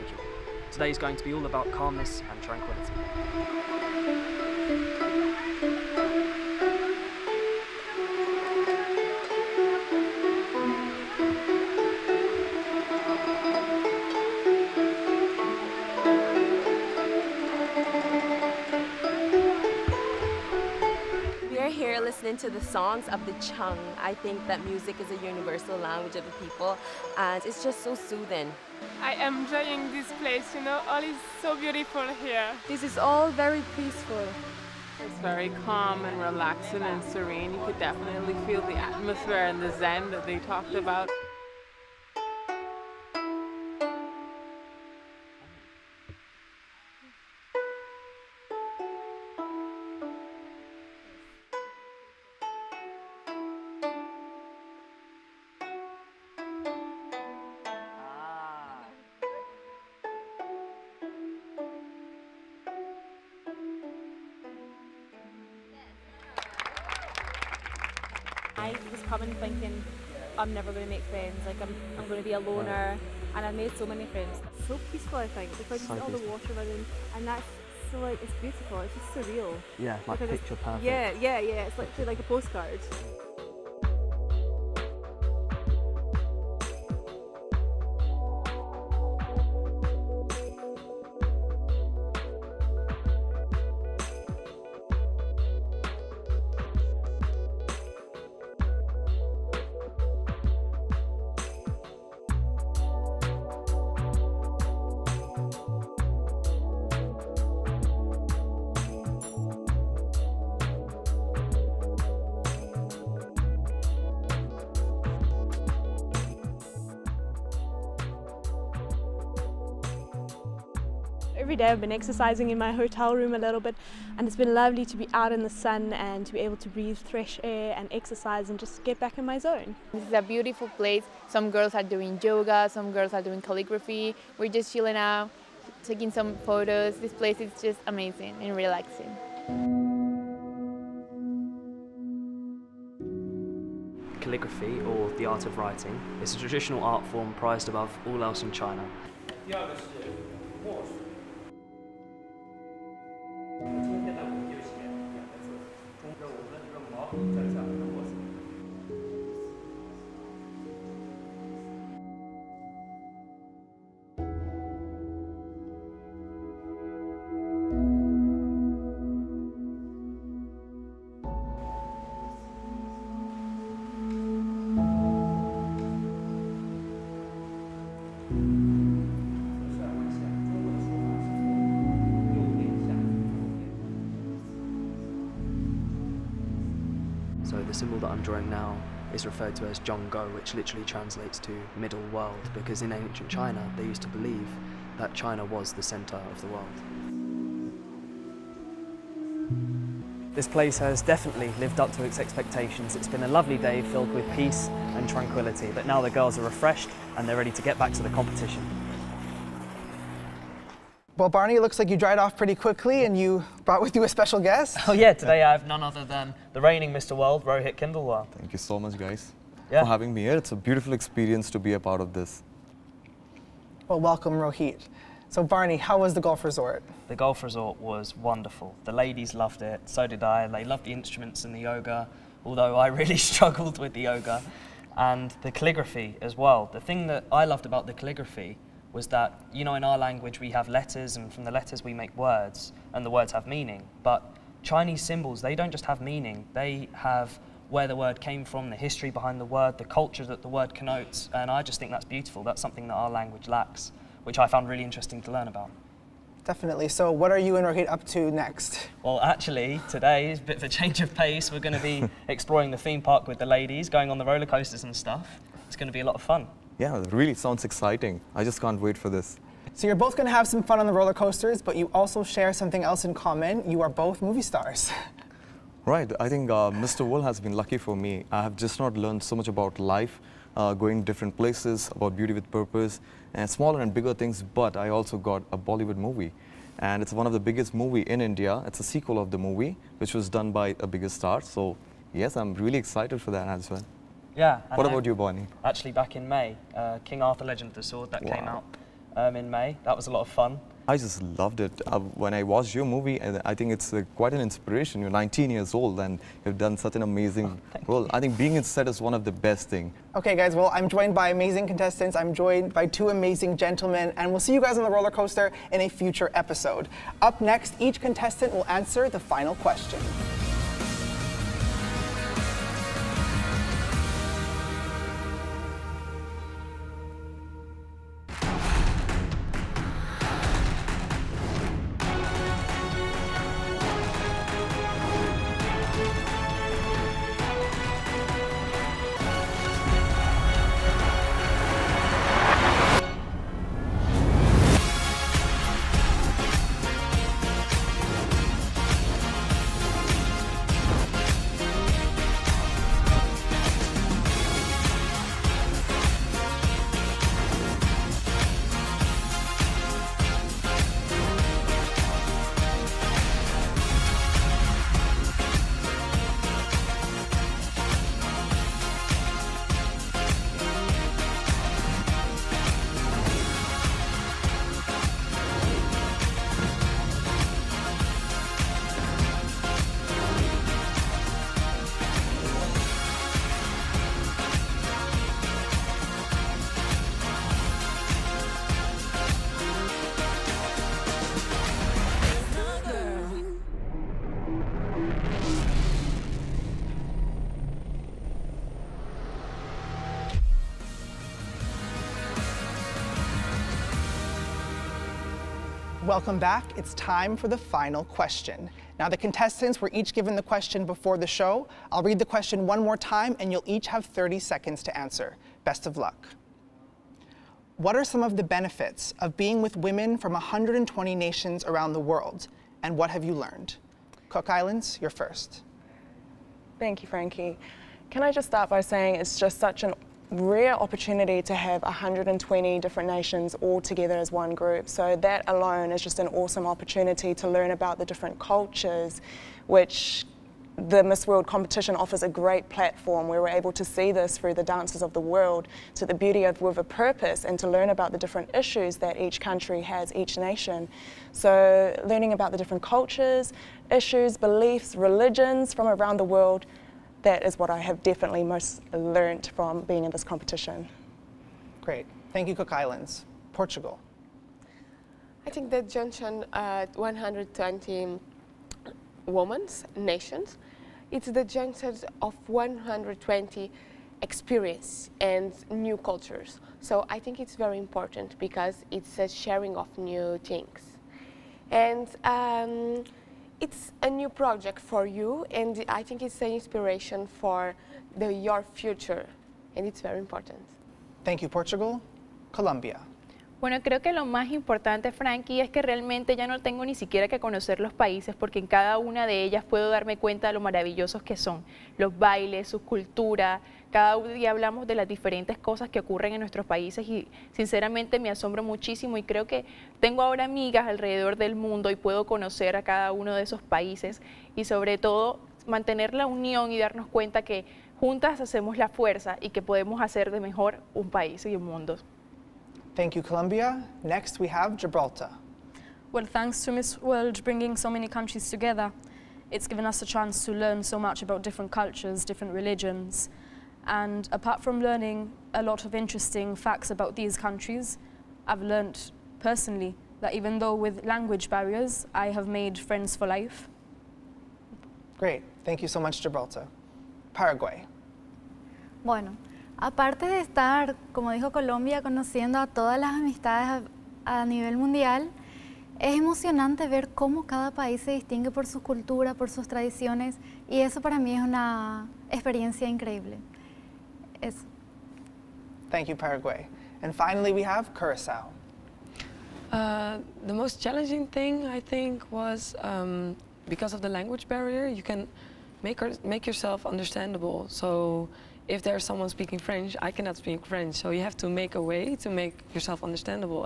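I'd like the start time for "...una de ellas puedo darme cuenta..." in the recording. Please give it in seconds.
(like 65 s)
498 s.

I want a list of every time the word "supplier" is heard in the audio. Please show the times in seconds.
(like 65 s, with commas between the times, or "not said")
not said.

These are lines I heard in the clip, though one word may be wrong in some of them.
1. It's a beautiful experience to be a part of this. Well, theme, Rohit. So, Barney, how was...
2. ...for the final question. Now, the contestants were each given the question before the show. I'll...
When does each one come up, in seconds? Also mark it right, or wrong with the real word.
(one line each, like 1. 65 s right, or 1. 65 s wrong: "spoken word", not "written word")
1. 220 s wrong: "welcome", not "theme"
2. 407 s right.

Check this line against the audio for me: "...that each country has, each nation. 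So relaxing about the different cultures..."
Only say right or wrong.
wrong.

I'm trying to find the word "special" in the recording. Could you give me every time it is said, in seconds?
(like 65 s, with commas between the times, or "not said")
214 s.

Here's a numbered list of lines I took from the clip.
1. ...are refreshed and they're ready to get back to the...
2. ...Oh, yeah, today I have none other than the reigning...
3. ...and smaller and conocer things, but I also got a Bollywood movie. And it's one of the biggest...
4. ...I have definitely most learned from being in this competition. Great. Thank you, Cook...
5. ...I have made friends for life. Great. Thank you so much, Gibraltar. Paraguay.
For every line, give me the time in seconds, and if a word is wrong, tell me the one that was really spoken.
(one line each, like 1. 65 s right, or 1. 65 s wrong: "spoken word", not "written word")
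1. 206 s right
2. 214 s right
3. 283 s wrong: "bigger", not "conocer"
4. 457 s right
5. 542 s right.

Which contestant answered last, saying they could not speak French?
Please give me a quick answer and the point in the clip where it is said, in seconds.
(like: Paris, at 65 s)
Curacao, at 567 s.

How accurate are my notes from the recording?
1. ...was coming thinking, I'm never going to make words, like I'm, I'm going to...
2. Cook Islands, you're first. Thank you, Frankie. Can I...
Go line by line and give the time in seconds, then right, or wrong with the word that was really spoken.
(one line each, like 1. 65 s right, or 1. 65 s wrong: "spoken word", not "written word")
1. 68 s wrong: "friends", not "words"
2. 424 s right.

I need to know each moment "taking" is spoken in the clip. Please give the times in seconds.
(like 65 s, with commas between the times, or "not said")
135 s.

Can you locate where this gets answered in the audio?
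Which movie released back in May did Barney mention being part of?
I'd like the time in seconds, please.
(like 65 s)
297 s.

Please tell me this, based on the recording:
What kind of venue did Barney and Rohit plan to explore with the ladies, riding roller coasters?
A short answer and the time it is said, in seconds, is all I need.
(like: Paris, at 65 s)
theme park, at 262 s.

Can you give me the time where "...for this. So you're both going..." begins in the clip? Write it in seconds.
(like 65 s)
268 s.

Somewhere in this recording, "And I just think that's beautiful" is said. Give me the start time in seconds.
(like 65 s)
251 s.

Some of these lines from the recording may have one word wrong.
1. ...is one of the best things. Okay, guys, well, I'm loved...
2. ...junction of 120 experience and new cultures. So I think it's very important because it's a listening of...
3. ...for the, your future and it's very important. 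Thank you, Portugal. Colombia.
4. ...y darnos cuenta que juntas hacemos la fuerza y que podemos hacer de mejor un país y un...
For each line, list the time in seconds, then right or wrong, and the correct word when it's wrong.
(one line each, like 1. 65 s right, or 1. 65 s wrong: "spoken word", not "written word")
1. 308 s wrong: "joined", not "loved"
2. 471 s wrong: "sharing", not "listening"
3. 487 s right
4. 516 s right.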